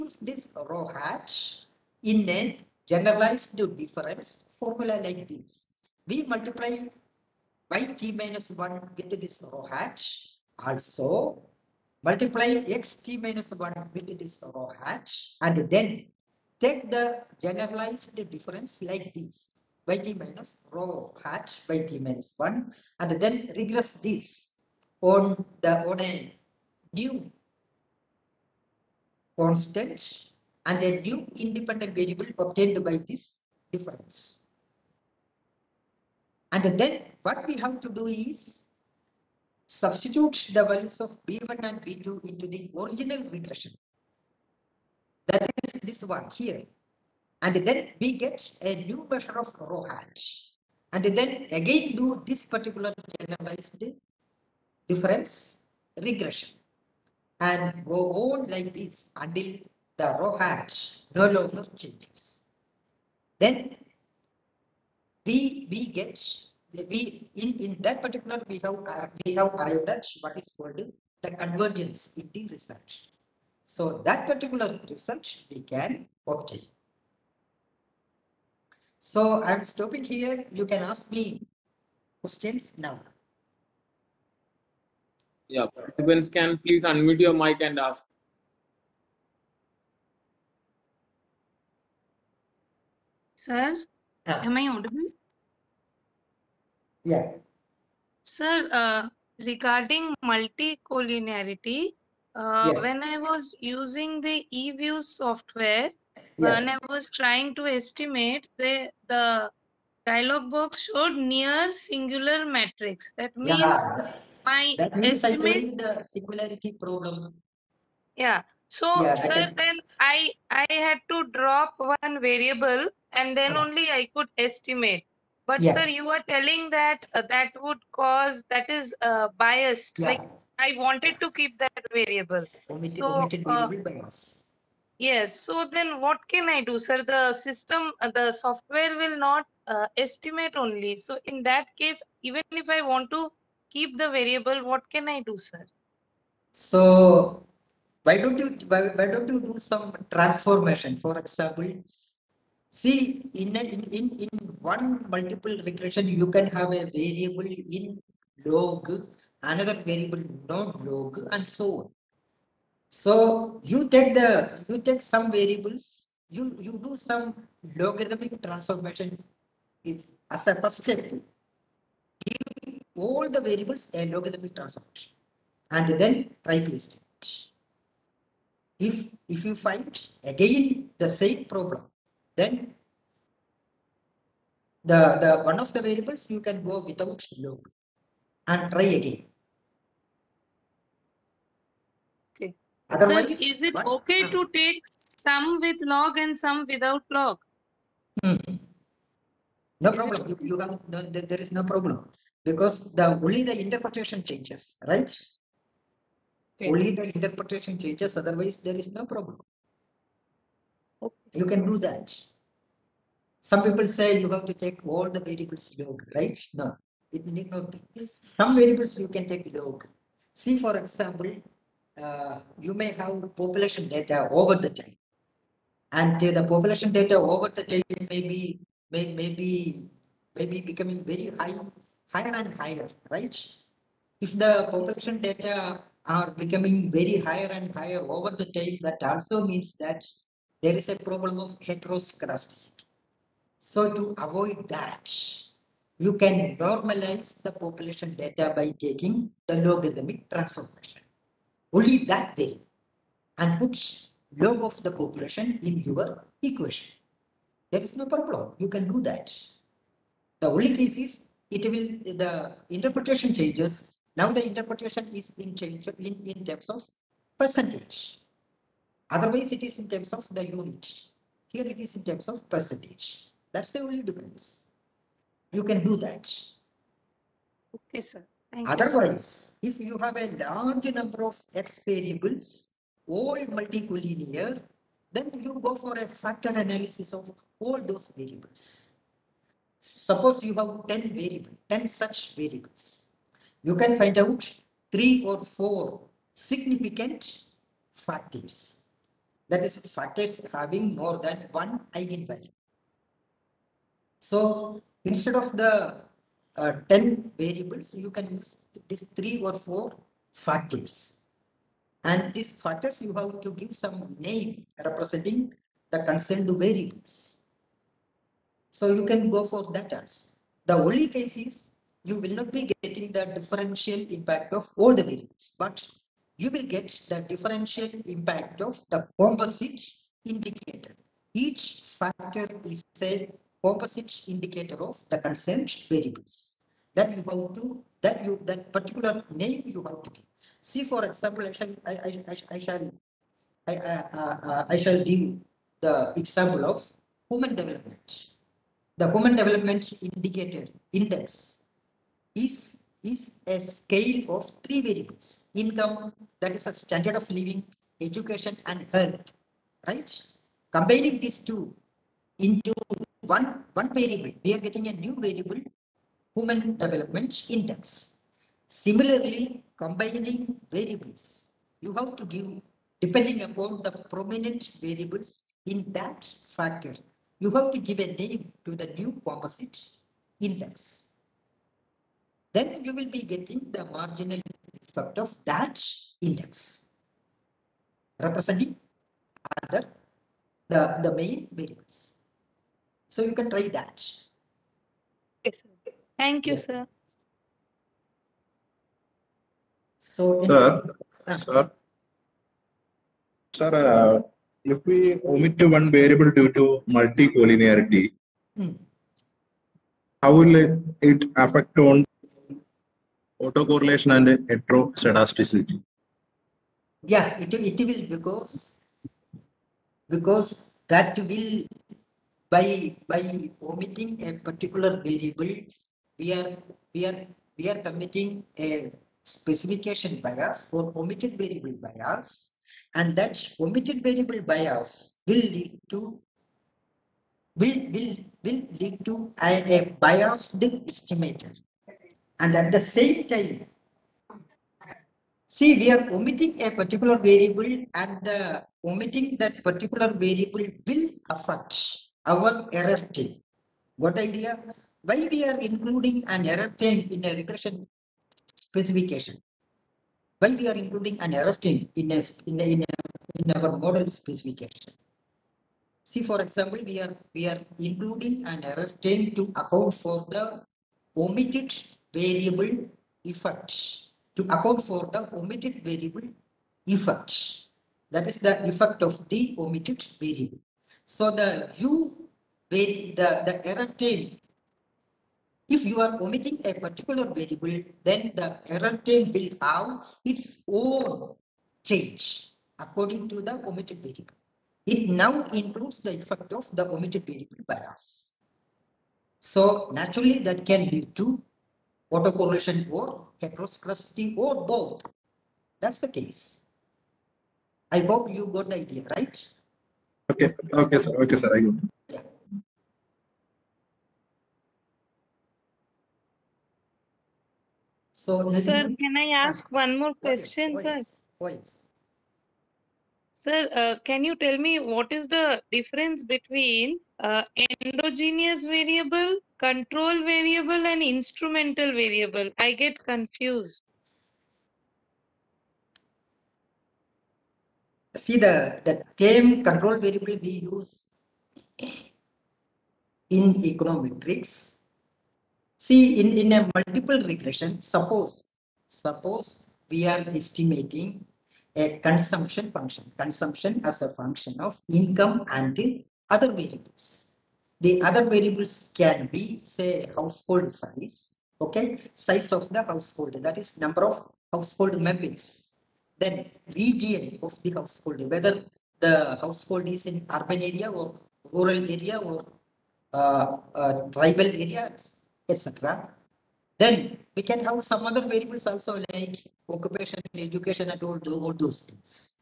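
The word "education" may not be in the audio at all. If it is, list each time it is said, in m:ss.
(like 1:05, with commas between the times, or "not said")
5:57, 9:40.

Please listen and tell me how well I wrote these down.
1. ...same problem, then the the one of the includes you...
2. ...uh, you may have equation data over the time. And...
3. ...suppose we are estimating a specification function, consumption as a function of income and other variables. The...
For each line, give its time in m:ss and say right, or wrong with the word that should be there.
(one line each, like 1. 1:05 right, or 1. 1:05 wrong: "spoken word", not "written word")
1. 3:01 wrong: "variables", not "includes"
2. 3:42 wrong: "population", not "equation"
3. 9:08 wrong: "consumption", not "specification".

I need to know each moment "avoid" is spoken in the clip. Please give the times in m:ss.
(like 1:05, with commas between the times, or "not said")
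4:04.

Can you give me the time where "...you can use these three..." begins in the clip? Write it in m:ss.
5:07.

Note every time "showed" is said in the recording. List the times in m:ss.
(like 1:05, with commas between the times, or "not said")
1:50.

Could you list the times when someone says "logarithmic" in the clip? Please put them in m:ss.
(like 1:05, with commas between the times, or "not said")
2:47, 2:54, 4:09.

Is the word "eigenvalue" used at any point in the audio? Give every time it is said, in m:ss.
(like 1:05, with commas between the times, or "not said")
5:01.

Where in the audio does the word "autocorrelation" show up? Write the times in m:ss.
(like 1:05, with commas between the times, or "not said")
6:53, 8:22.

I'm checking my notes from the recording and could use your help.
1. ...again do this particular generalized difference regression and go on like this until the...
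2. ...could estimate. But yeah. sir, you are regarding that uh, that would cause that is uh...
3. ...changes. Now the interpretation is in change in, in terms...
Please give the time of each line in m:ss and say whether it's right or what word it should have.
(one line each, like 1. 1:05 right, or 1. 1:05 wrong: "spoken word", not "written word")
1. 0:51 right
2. 2:04 wrong: "telling", not "regarding"
3. 4:23 right.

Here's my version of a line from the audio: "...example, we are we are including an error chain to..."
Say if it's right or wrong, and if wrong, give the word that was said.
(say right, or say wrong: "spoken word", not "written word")
right.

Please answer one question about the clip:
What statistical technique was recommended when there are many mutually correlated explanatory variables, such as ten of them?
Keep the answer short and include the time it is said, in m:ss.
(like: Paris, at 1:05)
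Factor analysis, at 4:46.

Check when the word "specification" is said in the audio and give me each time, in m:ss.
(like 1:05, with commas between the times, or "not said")
7:09, 7:38, 7:44.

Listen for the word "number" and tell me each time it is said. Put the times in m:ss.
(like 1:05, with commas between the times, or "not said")
4:40, 9:23.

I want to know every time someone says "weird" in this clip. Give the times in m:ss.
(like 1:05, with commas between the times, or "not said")
not said.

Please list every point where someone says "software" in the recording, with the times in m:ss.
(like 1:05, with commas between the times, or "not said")
1:45, 2:18.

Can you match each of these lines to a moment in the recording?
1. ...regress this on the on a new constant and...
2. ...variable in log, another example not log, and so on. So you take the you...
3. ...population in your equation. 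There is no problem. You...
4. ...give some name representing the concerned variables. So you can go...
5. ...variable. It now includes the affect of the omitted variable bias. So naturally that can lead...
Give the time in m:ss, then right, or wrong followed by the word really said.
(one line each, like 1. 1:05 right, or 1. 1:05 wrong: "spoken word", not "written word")
1. 0:23 right
2. 2:36 wrong: "variable", not "example"
3. 4:14 right
4. 5:13 right
5. 8:14 wrong: "effect", not "affect".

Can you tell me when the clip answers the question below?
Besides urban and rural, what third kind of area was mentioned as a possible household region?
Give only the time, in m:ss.
9:34.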